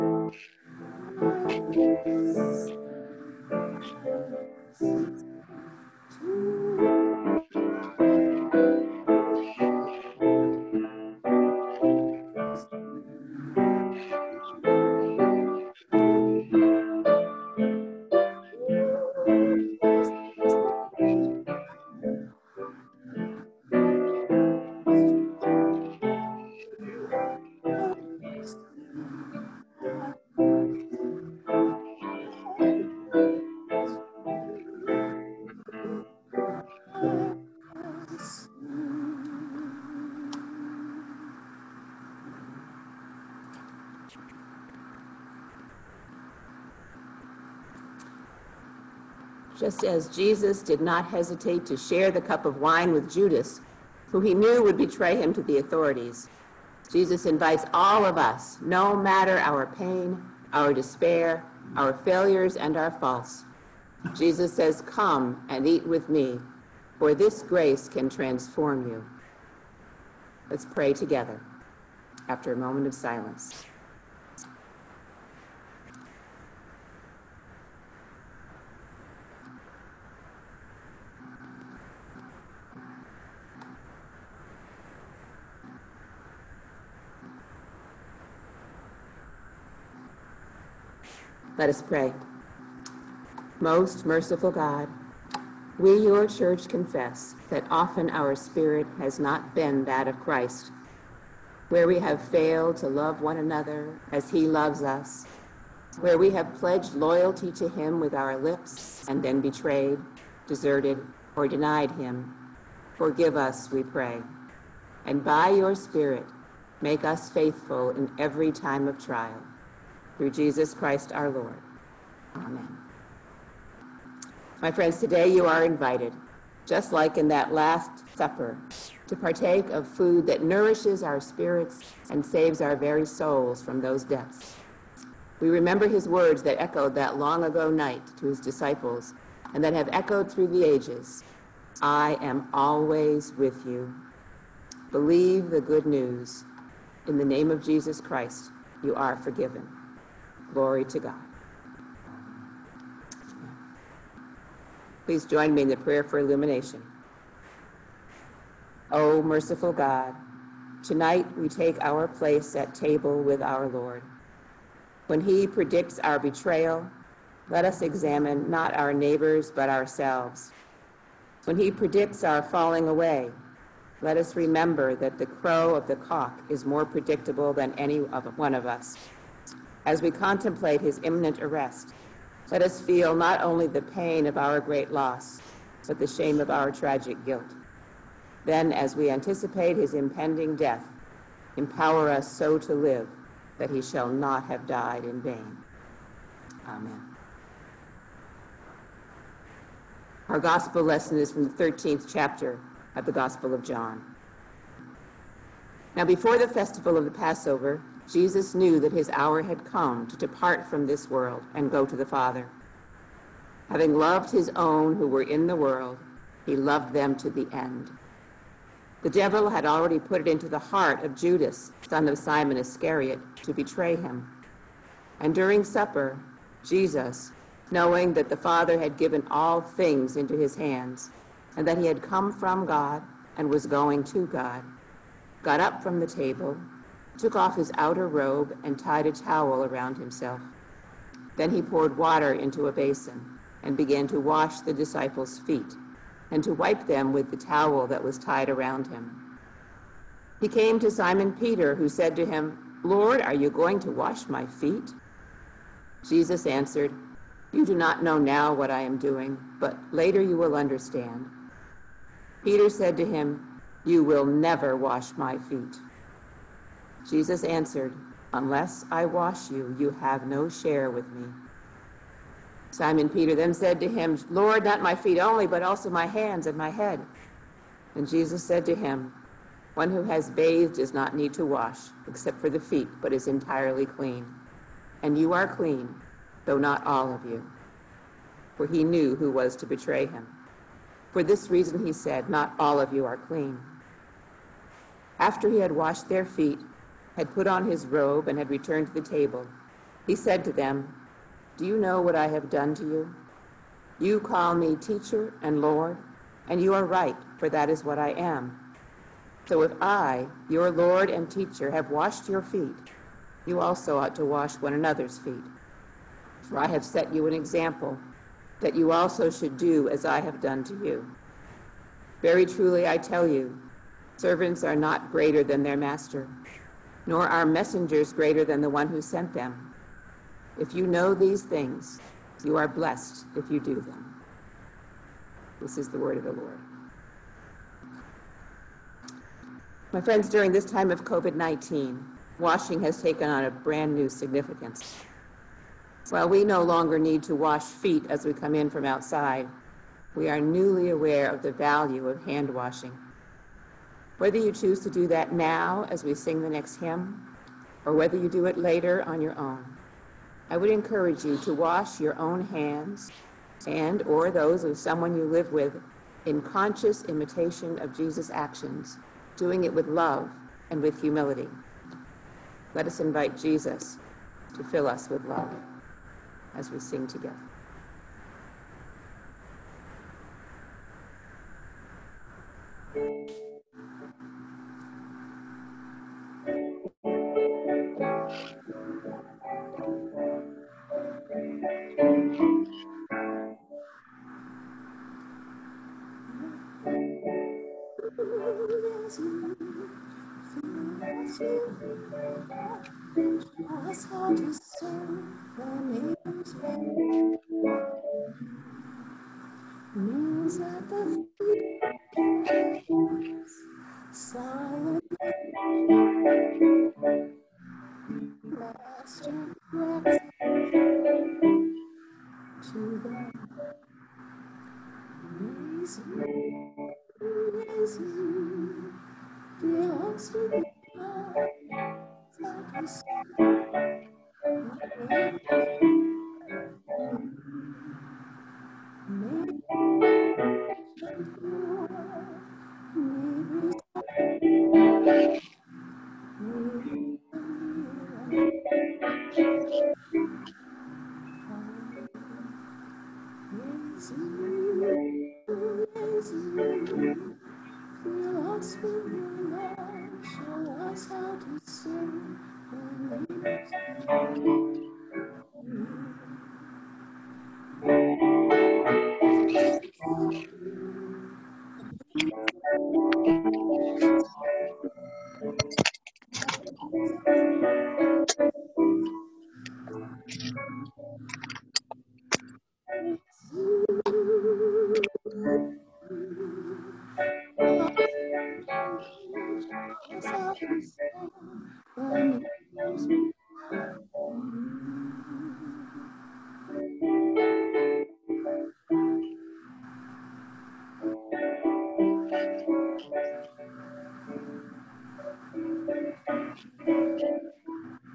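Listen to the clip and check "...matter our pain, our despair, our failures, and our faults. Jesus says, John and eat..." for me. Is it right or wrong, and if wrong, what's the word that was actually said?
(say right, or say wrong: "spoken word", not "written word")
wrong: "Come", not "John".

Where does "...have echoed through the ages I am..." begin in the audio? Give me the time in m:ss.
2:19.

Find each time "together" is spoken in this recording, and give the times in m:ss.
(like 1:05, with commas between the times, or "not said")
1:10, 6:17.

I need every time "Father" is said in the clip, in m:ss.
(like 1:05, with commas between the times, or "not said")
3:32, 3:48.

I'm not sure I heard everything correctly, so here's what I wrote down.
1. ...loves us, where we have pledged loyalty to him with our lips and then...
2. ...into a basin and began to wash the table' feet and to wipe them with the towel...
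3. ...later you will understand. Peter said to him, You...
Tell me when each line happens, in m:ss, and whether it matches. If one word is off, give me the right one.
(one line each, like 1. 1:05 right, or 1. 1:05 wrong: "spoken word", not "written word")
1. 1:44 right
2. 4:02 wrong: "disciples", not "table"
3. 4:19 right.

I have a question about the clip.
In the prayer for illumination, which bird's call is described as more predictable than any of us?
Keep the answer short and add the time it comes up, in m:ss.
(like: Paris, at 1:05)
the cock, at 2:55.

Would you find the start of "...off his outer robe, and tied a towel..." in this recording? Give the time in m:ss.
3:57.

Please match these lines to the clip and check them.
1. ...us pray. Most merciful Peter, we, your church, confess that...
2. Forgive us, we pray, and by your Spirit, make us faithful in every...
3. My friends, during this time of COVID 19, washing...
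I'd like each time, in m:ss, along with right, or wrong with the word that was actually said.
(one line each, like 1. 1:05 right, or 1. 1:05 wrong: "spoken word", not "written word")
1. 1:31 wrong: "God", not "Peter"
2. 1:52 right
3. 5:39 right.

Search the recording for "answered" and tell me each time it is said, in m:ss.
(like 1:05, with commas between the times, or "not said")
4:16, 4:27.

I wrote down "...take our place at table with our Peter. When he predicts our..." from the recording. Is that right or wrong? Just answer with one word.
wrong.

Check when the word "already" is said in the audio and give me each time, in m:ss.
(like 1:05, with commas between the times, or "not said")
3:39.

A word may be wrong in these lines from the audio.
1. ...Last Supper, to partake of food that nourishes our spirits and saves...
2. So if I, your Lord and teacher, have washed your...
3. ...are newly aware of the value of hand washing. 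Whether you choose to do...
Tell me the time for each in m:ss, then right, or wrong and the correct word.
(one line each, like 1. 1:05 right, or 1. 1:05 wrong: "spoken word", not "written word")
1. 2:07 right
2. 5:09 right
3. 5:50 right.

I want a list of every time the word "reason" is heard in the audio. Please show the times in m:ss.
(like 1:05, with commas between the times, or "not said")
4:51.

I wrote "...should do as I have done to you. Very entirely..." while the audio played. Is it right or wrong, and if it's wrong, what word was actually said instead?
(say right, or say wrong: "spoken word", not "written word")
wrong: "truly", not "entirely".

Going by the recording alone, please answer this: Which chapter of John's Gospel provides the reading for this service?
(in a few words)
13th.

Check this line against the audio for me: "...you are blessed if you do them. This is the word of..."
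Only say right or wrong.
right.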